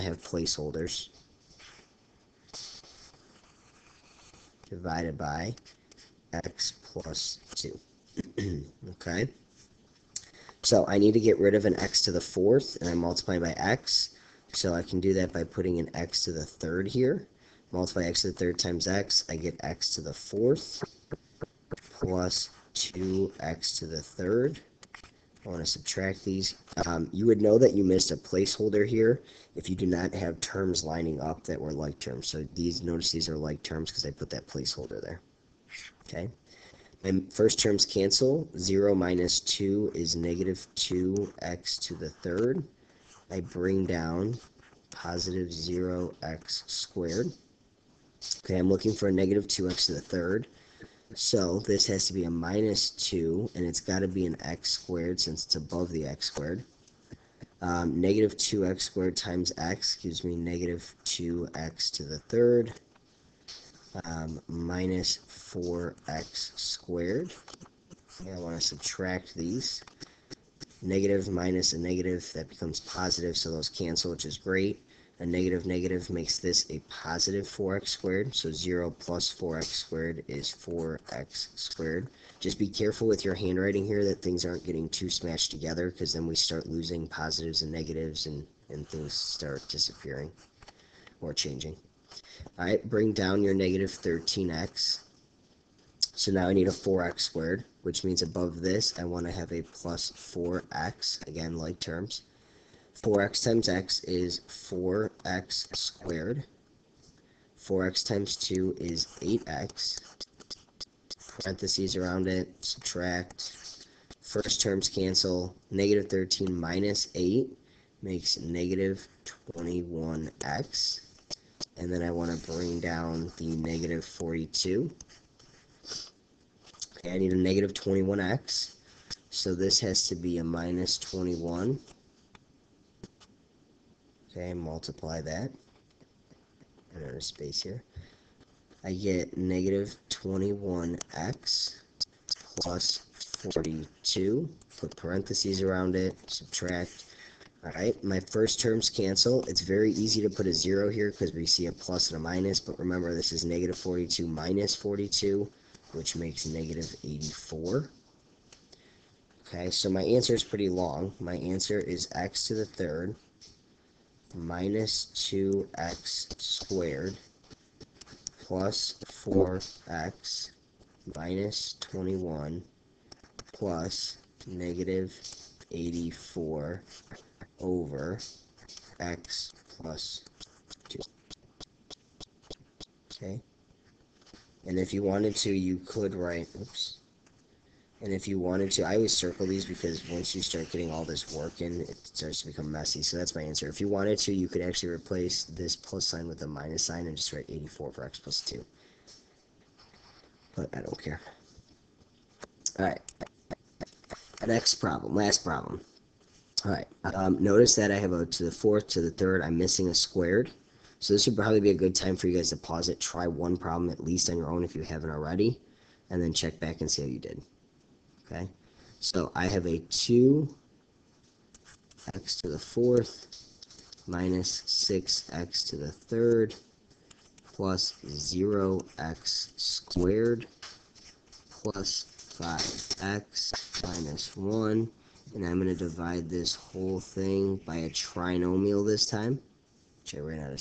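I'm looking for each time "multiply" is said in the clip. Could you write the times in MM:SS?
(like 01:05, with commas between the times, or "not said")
00:12, 00:17, 02:14.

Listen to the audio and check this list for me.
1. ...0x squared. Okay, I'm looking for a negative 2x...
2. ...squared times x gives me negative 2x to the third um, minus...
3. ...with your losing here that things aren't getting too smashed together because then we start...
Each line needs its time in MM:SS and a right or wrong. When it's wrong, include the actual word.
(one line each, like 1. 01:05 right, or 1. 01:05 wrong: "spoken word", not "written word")
1. 00:45 right
2. 00:58 right
3. 01:23 wrong: "handwriting", not "losing".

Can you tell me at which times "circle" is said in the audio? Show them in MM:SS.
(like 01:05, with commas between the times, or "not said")
03:09.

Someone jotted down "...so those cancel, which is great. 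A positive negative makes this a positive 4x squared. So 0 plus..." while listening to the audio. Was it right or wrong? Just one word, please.
wrong.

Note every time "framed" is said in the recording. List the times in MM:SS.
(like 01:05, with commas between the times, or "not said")
not said.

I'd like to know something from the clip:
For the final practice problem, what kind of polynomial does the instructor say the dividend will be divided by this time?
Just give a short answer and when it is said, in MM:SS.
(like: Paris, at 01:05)
trinomial, at 03:57.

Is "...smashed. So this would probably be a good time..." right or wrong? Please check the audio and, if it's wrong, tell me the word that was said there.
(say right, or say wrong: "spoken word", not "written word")
wrong: "squared", not "smashed".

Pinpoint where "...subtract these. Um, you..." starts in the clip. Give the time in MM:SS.
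00:25.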